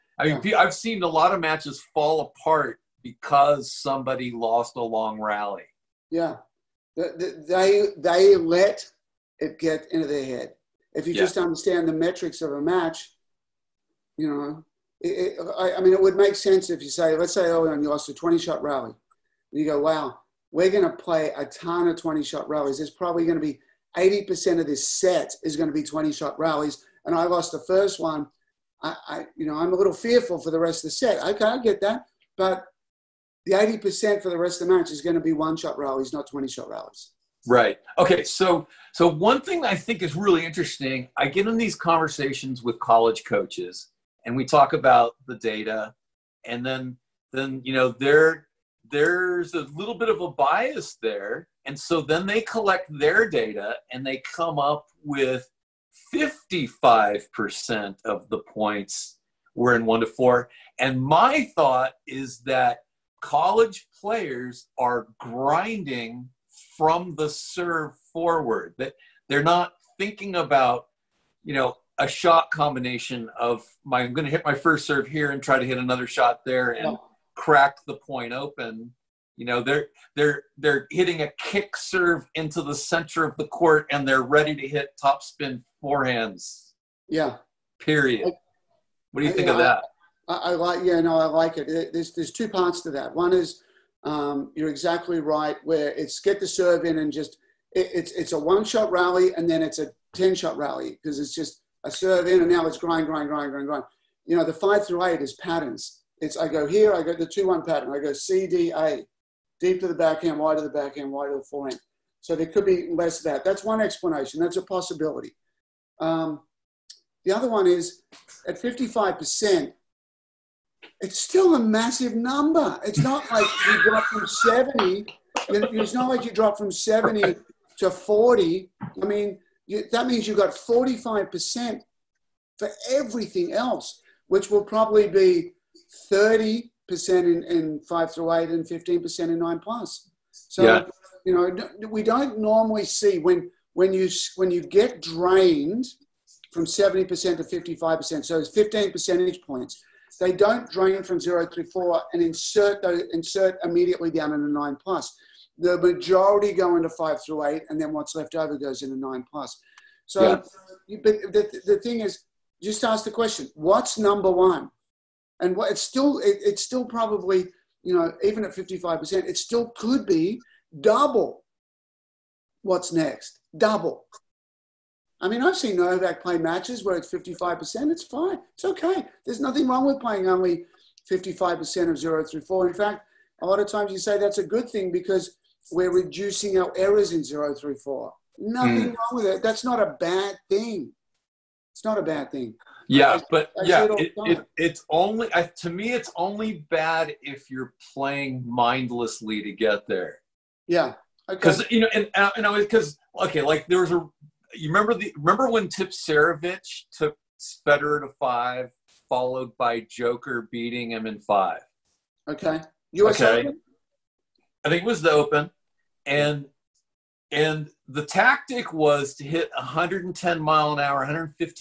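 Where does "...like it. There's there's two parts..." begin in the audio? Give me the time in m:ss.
1:31.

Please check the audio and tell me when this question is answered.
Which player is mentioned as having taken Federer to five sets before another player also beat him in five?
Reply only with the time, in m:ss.
3:25.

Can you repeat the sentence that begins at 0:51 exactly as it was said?
And so then they collect their data and they come up with 55% of the points were in one to four.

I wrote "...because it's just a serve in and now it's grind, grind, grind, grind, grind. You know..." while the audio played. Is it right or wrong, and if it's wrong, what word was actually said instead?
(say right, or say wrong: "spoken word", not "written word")
right.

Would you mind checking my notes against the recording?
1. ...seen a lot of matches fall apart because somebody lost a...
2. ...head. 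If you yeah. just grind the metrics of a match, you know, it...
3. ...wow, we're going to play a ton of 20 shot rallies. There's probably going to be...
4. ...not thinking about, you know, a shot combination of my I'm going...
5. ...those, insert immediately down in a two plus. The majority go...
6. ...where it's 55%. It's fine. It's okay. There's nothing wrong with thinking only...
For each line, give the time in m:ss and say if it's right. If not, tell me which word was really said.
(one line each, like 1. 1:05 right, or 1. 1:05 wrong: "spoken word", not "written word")
1. 0:00 right
2. 0:10 wrong: "understand", not "grind"
3. 0:19 right
4. 1:09 right
5. 2:32 wrong: "nine", not "two"
6. 2:56 wrong: "playing", not "thinking".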